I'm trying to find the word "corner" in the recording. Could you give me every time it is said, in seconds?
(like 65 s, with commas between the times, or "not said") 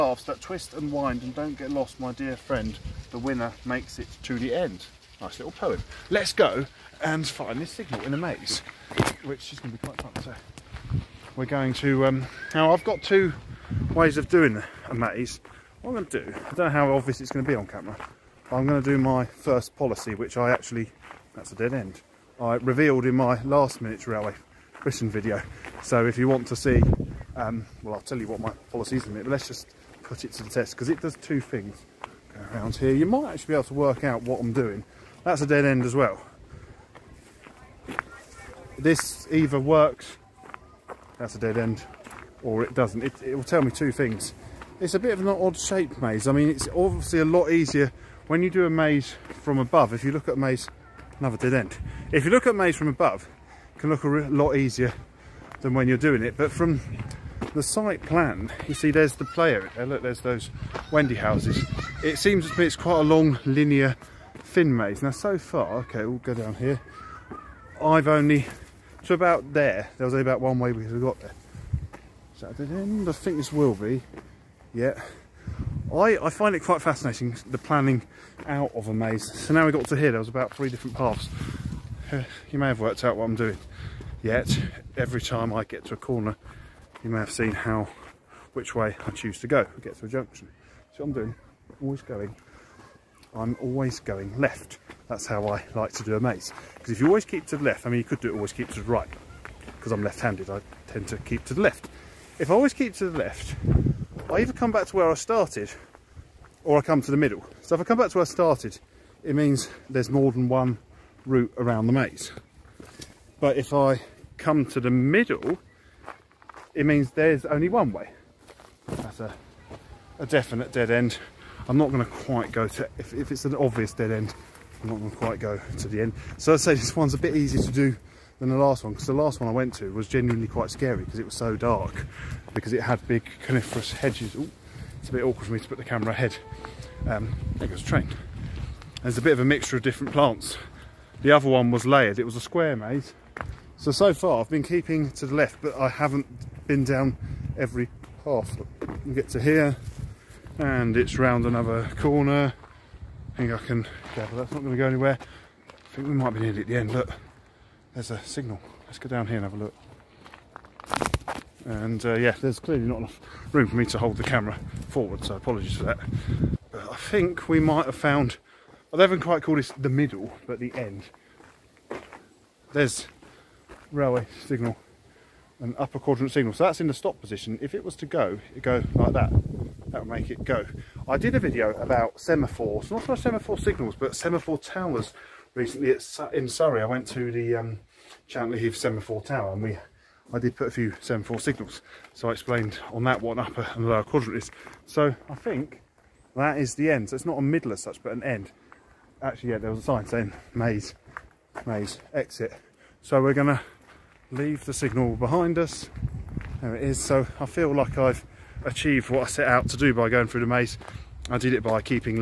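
85 s, 151 s.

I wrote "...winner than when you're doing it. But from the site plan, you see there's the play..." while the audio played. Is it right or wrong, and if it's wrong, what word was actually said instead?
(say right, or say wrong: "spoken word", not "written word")
wrong: "easier", not "winner".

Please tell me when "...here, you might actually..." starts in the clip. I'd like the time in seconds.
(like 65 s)
32 s.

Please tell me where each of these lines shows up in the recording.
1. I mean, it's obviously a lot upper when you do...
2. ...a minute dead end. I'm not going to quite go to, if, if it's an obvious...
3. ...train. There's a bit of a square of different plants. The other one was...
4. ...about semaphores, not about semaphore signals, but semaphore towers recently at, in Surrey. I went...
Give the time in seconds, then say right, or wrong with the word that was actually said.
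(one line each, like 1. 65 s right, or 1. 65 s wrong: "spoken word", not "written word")
1. 46 s wrong: "easier", not "upper"
2. 120 s wrong: "definite", not "minute"
3. 137 s wrong: "mixture", not "square"
4. 181 s right.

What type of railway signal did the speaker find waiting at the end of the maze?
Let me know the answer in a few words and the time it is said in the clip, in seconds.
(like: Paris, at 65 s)
Upper quadrant signal, at 175 s.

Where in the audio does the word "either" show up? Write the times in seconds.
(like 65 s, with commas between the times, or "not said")
39 s, 104 s.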